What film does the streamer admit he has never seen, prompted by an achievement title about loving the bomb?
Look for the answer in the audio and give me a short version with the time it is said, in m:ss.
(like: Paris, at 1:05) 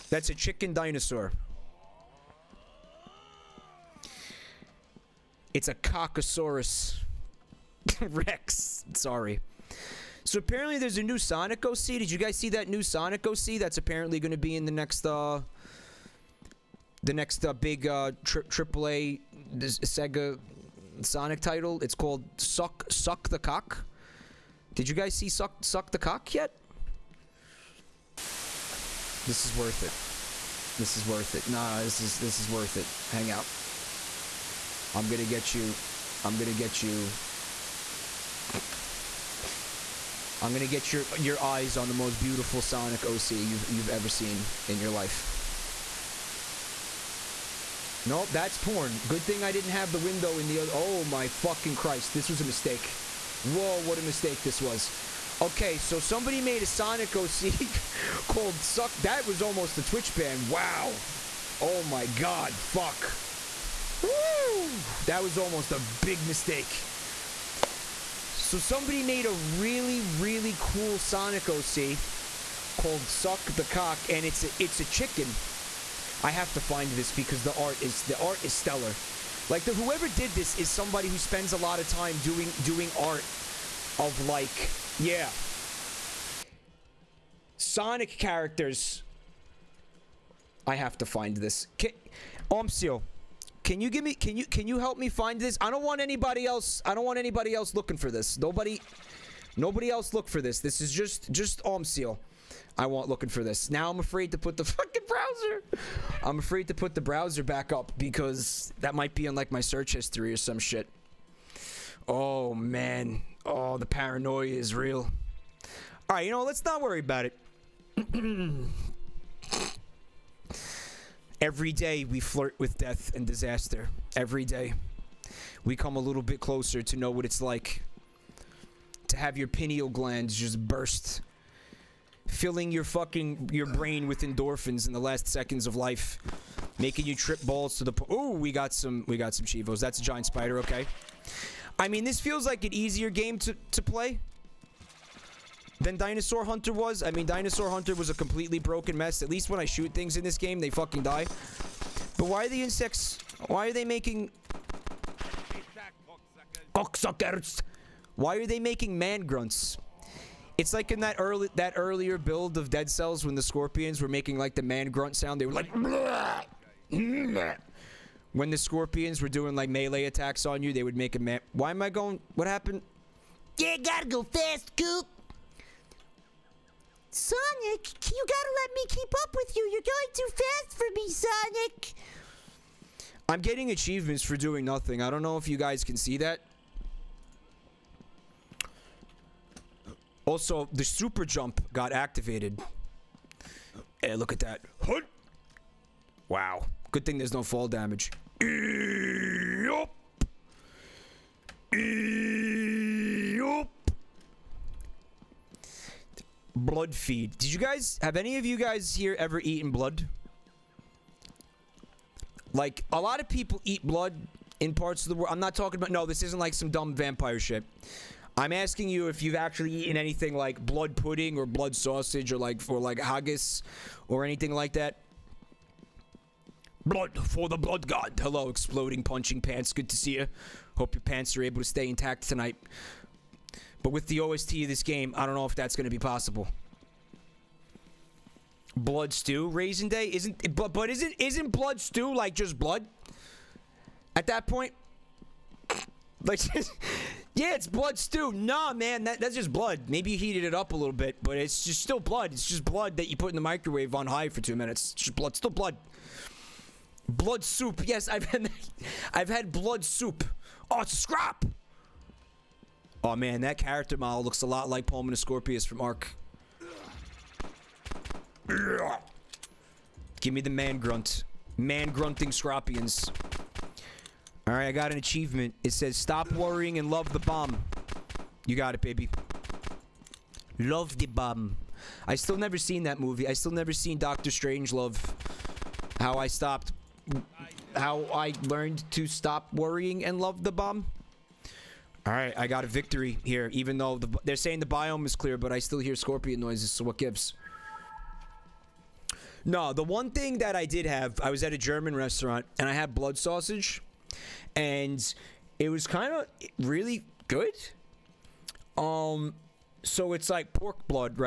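Doctor Strangelove, at 4:43.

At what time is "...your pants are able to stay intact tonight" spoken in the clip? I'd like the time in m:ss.
3:50.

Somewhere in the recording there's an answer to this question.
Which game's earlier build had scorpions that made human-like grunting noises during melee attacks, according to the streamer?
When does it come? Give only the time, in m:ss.
2:42.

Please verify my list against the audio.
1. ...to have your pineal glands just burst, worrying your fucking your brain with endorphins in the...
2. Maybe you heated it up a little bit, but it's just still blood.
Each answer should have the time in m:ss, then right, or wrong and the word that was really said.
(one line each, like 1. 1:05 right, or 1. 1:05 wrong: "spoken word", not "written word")
1. 2:09 wrong: "filling", not "worrying"
2. 4:09 right.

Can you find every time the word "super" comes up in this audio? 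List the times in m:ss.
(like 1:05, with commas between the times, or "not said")
3:10.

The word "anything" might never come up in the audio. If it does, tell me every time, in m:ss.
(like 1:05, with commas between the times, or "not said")
3:39, 3:44.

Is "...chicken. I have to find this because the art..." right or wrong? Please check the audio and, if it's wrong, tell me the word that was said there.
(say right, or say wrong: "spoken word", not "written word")
right.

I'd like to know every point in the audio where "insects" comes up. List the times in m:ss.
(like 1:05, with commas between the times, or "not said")
2:32.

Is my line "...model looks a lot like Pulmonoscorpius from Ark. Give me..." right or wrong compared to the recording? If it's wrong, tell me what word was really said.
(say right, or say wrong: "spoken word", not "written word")
right.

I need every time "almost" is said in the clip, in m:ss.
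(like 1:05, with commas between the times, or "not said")
0:59, 1:05.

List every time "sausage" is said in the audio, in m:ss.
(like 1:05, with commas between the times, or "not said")
3:41, 5:03.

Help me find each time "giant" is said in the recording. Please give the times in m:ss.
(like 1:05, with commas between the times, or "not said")
2:20.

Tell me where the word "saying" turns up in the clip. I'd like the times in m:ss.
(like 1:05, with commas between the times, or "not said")
4:54.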